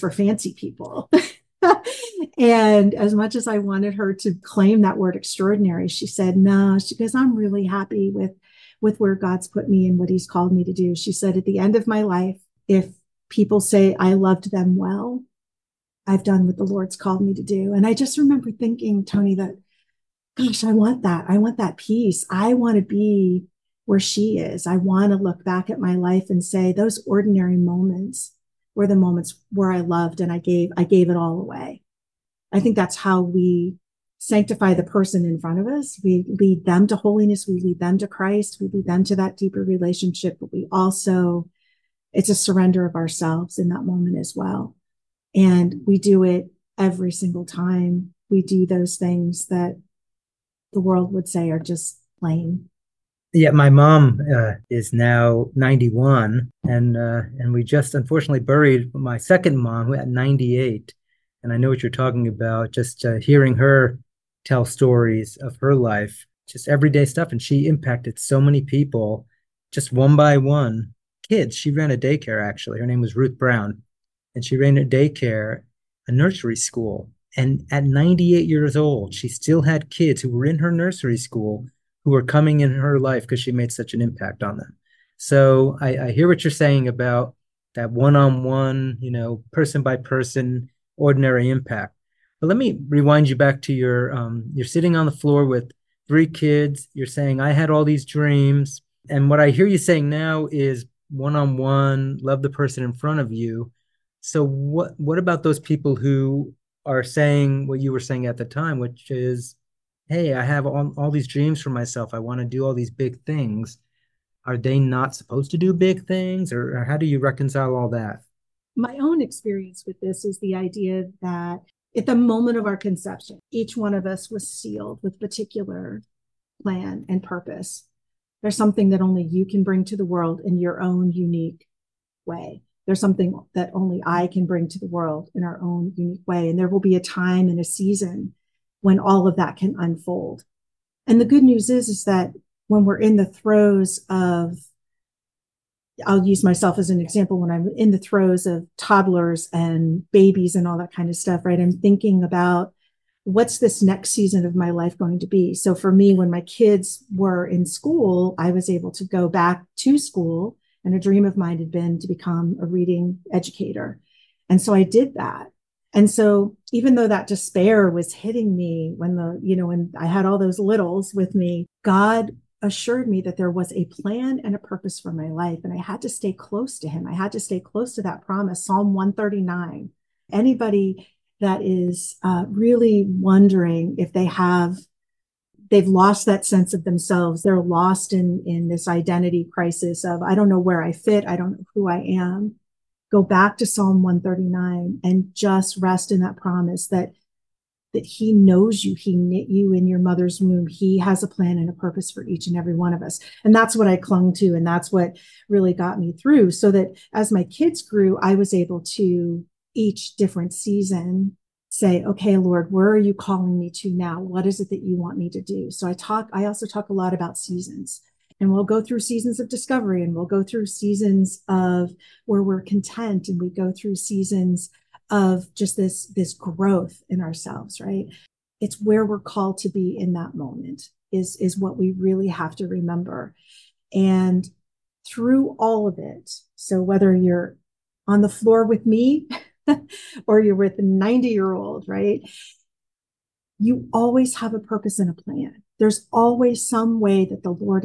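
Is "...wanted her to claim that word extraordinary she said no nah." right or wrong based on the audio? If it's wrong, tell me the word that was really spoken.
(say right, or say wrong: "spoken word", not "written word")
right.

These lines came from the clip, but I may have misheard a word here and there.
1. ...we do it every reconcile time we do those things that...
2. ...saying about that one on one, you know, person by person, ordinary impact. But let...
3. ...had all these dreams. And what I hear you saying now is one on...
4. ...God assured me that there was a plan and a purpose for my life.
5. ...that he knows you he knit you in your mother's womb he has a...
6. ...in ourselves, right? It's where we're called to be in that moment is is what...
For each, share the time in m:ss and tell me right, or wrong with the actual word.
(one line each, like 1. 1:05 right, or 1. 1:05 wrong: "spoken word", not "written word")
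1. 0:45 wrong: "single", not "reconcile"
2. 1:26 right
3. 1:37 right
4. 2:51 right
5. 3:17 right
6. 3:47 right.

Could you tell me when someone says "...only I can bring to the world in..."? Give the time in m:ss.
2:13.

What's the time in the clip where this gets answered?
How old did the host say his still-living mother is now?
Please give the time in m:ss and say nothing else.
0:55.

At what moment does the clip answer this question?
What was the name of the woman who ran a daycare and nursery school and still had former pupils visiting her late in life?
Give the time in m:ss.
1:13.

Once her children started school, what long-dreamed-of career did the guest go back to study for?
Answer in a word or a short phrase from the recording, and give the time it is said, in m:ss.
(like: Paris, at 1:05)
reading educator, at 2:42.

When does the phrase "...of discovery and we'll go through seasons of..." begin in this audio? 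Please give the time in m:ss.
3:39.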